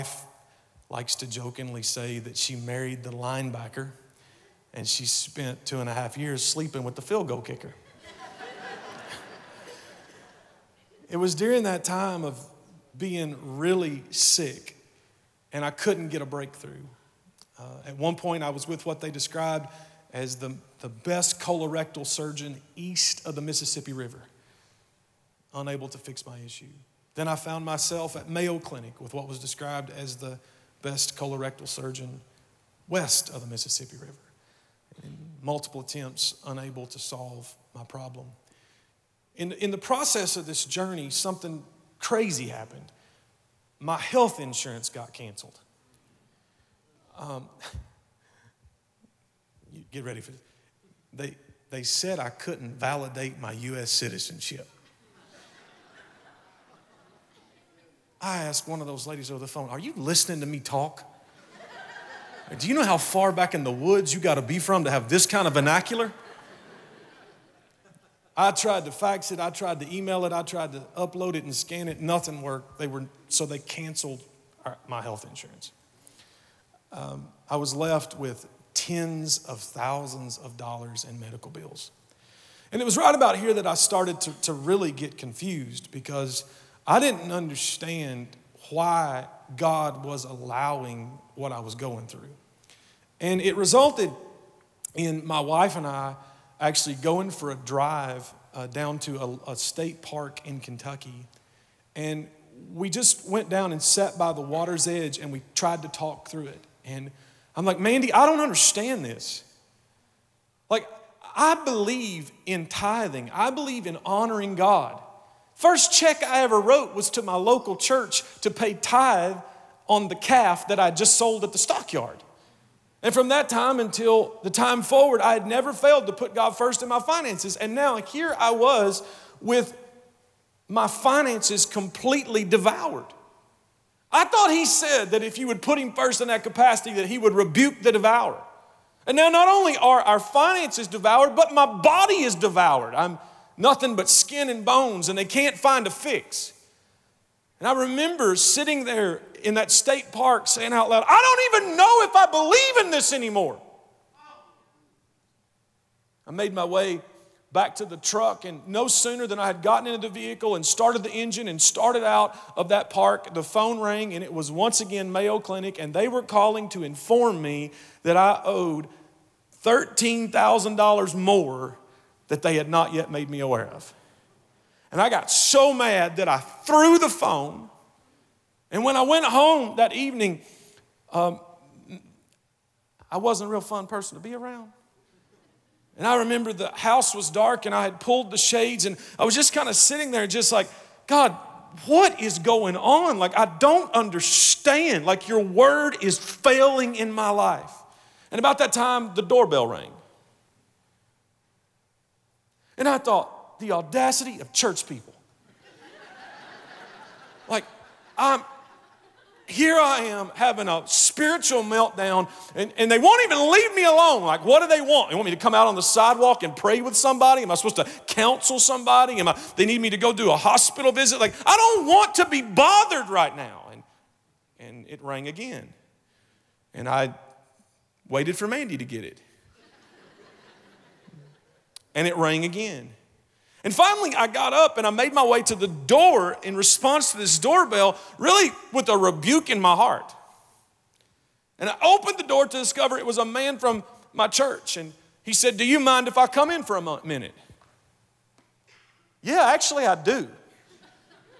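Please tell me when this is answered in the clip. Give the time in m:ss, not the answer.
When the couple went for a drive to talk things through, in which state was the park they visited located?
1:40.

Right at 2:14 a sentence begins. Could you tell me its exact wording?
I thought he said that if you would put him first in that capacity, that he would rebuke the devourer.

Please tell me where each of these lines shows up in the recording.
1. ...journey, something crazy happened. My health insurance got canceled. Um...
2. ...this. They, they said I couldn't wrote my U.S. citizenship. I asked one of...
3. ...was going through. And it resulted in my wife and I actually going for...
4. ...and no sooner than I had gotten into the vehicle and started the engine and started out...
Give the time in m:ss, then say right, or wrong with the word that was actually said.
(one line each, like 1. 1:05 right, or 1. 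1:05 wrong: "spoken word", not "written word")
1. 0:40 right
2. 0:50 wrong: "validate", not "wrote"
3. 1:31 right
4. 2:38 right.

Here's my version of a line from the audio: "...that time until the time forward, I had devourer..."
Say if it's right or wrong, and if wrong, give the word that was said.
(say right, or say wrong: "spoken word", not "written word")
wrong: "never", not "devourer".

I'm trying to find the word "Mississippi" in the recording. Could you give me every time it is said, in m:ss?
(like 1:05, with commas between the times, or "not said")
0:23, 0:33.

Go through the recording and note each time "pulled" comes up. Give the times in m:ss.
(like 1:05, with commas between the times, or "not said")
3:07.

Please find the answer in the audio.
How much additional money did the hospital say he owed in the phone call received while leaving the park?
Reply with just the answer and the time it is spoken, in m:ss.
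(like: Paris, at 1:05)
$13,000, at 2:49.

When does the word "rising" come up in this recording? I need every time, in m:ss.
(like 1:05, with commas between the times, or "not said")
not said.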